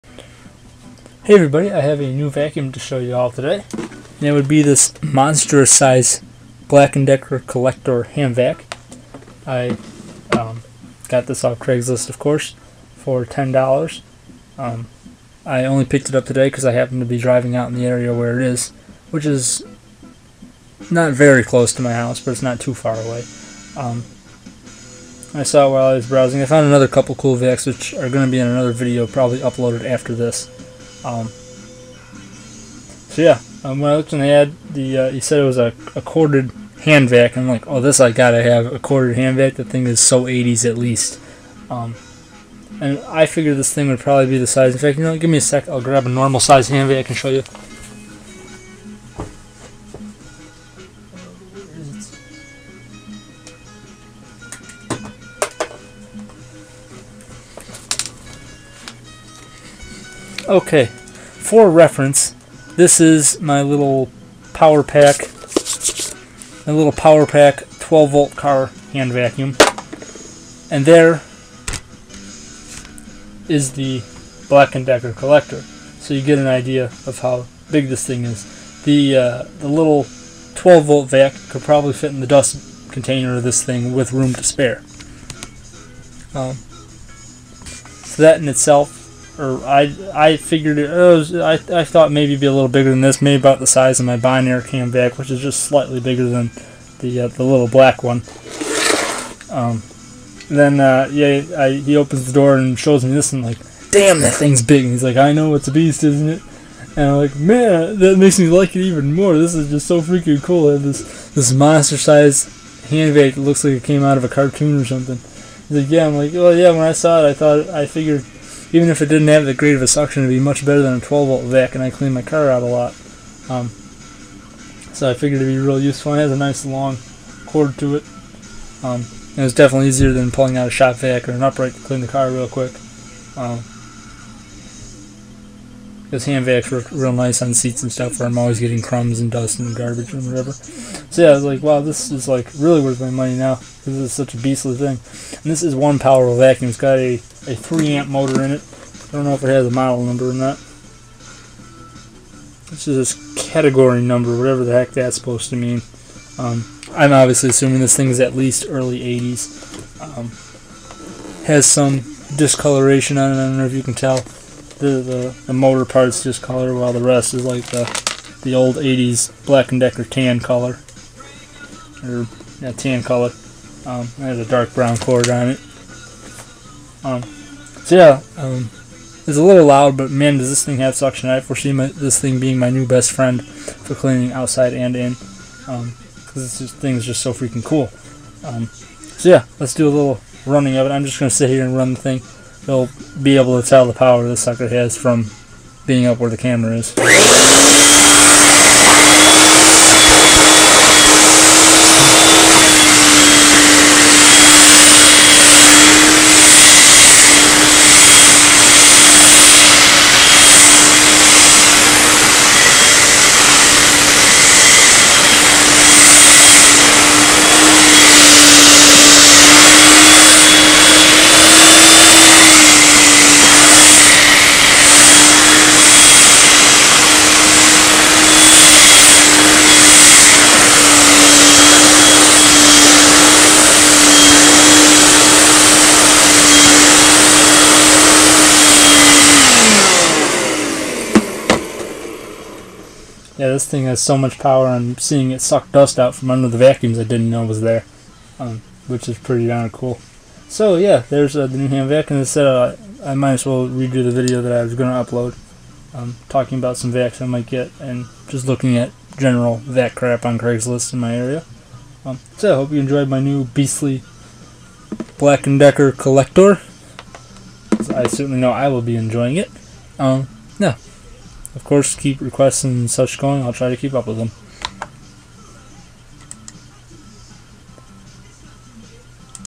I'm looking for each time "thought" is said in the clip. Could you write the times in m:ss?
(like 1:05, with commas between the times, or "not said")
1:31, 1:57.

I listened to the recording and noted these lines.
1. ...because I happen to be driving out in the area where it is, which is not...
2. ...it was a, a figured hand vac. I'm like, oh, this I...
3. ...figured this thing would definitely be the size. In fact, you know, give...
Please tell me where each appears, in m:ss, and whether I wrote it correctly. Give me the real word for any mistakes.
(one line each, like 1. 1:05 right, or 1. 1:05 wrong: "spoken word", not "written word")
1. 0:16 right
2. 0:35 wrong: "corded", not "figured"
3. 0:43 wrong: "probably", not "definitely".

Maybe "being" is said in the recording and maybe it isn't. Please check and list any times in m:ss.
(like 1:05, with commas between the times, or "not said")
3:02, 3:15.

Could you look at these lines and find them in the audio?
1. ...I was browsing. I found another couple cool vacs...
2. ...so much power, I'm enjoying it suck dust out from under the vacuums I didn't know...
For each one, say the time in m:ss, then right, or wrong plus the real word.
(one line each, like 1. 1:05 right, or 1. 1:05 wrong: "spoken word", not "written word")
1. 0:25 right
2. 4:03 wrong: "seeing", not "enjoying".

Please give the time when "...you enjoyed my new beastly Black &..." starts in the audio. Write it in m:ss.
4:22.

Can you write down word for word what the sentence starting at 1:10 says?
And there is the Black & Decker collector.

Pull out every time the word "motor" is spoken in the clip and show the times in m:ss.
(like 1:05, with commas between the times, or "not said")
2:28, 2:45.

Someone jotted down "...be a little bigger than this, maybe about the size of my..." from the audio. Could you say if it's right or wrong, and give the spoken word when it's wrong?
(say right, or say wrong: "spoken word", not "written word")
right.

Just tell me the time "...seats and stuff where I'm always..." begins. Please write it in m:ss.
2:17.